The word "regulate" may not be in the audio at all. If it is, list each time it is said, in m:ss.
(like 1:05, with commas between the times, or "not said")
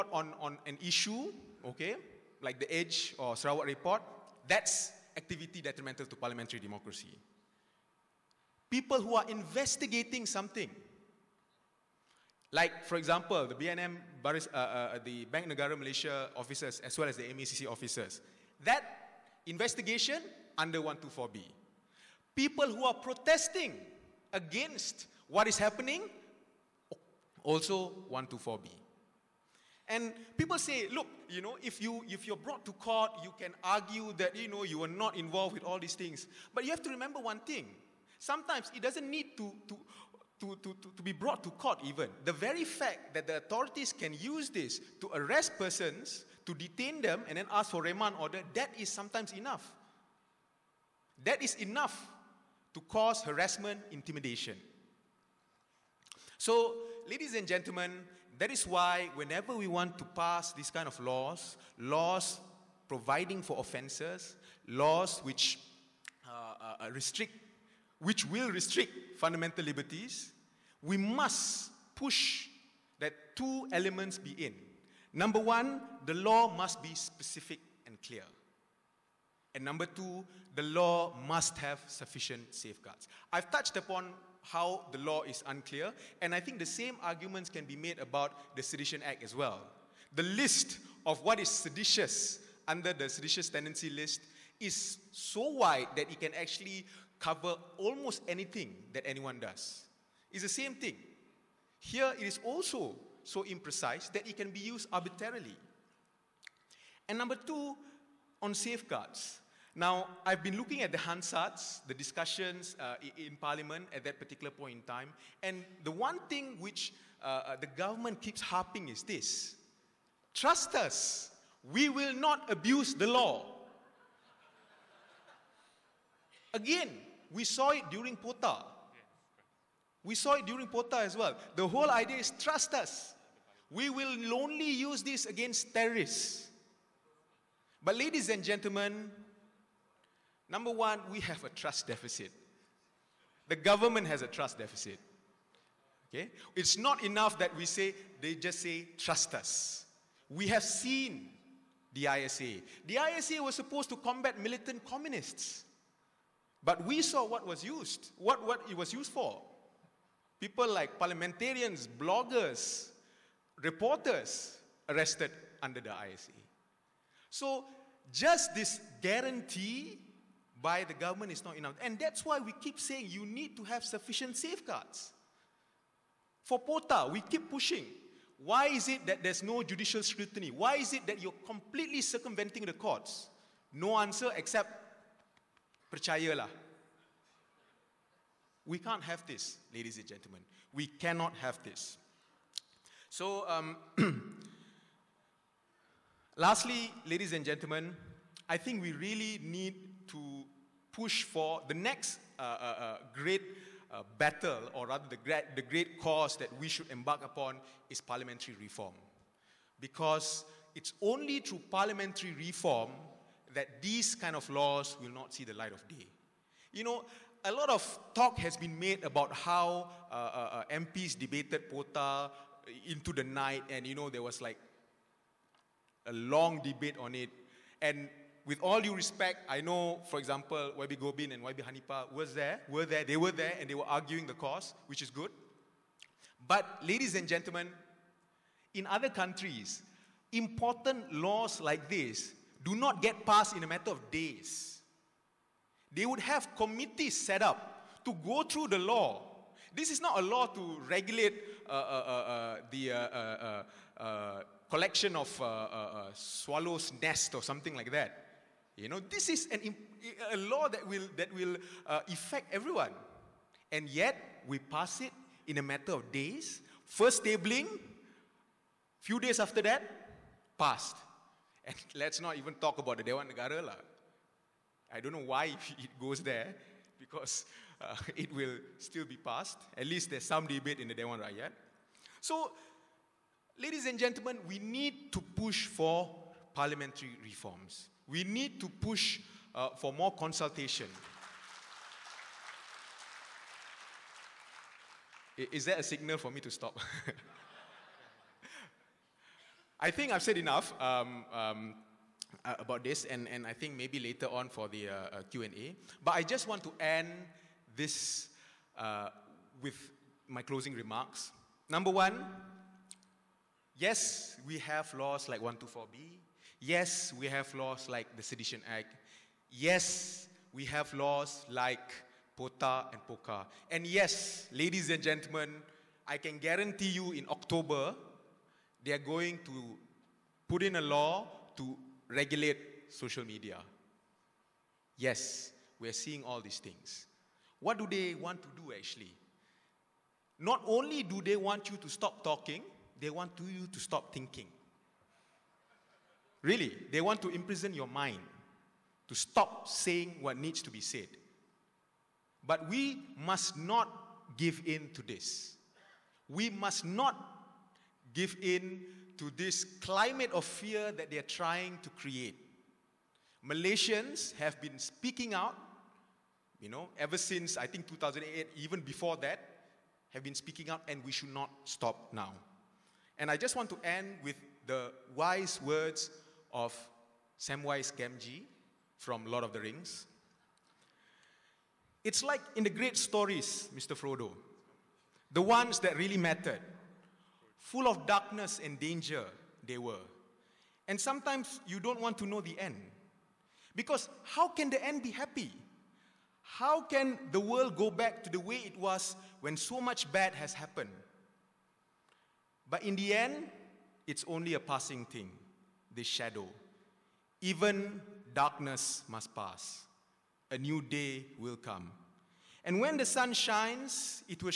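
4:10, 5:32.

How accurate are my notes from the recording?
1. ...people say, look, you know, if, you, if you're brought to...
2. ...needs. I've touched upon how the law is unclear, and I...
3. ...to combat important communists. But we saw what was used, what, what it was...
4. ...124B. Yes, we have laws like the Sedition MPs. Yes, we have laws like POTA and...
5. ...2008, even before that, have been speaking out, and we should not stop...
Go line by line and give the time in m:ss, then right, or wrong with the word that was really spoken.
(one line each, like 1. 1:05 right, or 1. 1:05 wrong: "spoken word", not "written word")
1. 0:30 right
2. 1:22 wrong: "safeguards", not "needs"
3. 2:33 wrong: "militant", not "important"
4. 5:15 wrong: "Act", not "MPs"
5. 6:07 right.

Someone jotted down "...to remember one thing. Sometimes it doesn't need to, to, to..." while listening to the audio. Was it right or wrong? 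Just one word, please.
right.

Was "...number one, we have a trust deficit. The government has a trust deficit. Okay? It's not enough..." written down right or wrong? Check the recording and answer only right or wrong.
right.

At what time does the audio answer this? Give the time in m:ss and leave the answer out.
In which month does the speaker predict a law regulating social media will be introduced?
5:27.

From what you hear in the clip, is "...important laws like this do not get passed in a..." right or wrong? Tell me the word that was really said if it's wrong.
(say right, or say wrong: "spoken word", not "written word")
right.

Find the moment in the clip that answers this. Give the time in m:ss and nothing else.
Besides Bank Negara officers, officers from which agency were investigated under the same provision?
0:17.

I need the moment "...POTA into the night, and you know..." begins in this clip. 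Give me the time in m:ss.
3:41.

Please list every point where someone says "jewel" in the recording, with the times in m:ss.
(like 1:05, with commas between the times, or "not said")
not said.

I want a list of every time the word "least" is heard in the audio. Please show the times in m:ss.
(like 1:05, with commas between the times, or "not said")
4:39.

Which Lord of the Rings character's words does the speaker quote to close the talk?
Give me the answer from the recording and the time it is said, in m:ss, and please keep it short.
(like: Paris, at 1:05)
Samwise Gamgee, at 6:17.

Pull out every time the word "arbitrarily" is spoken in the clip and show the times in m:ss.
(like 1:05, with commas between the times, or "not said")
1:44.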